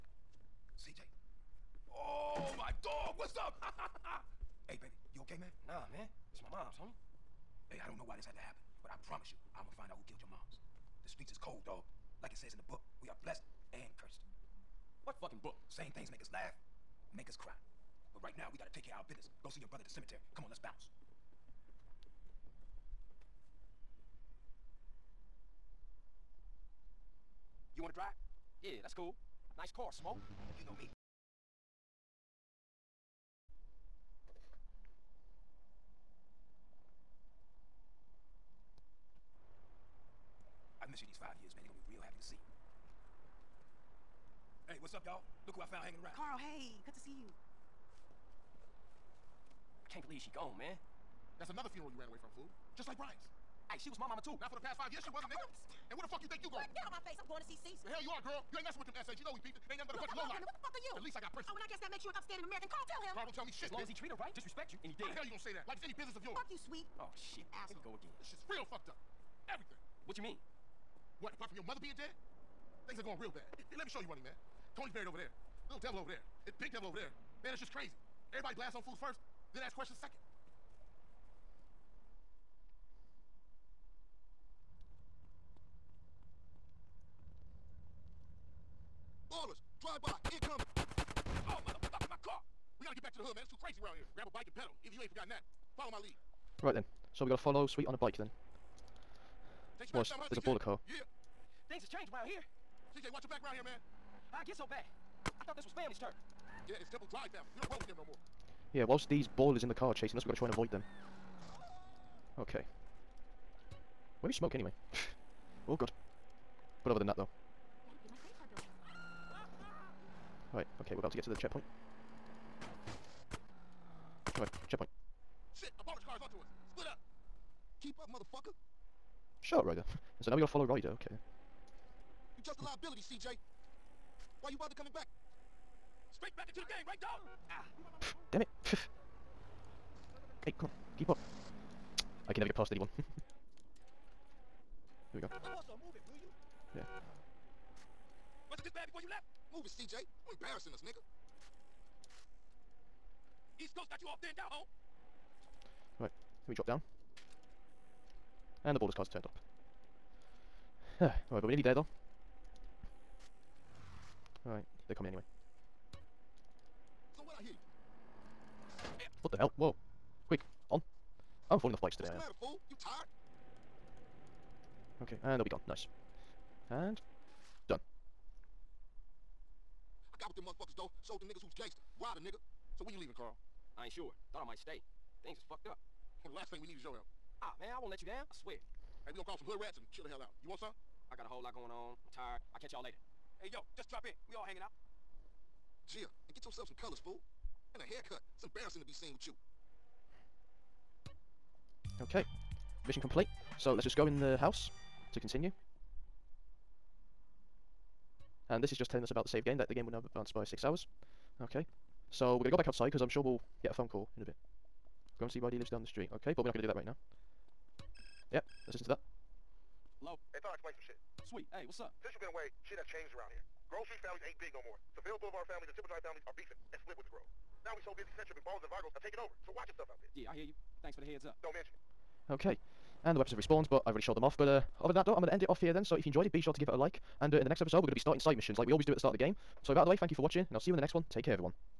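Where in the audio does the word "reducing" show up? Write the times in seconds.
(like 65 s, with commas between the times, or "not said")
not said.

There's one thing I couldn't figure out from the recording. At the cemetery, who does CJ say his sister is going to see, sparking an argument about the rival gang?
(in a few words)
Caesar.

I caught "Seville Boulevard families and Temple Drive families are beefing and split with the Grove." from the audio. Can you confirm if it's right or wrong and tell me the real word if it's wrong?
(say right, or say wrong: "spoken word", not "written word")
right.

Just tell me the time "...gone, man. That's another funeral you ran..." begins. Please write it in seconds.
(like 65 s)
50 s.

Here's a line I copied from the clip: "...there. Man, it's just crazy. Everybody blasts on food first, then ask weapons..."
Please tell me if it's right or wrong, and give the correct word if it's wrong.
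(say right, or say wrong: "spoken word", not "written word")
wrong: "questions", not "weapons".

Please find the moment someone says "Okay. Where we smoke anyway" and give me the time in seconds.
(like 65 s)
112 s.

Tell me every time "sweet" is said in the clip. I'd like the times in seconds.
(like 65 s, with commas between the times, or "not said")
66 s, 97 s, 221 s.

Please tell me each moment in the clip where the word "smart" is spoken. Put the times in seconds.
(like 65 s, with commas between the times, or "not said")
not said.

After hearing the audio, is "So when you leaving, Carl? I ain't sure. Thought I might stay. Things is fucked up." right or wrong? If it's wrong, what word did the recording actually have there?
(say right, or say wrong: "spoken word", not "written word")
right.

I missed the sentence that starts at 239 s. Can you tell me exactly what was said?
So with that out of the way, thank you for watching, and I'll see you in the next one.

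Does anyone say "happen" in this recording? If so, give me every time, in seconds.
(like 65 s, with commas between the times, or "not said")
8 s.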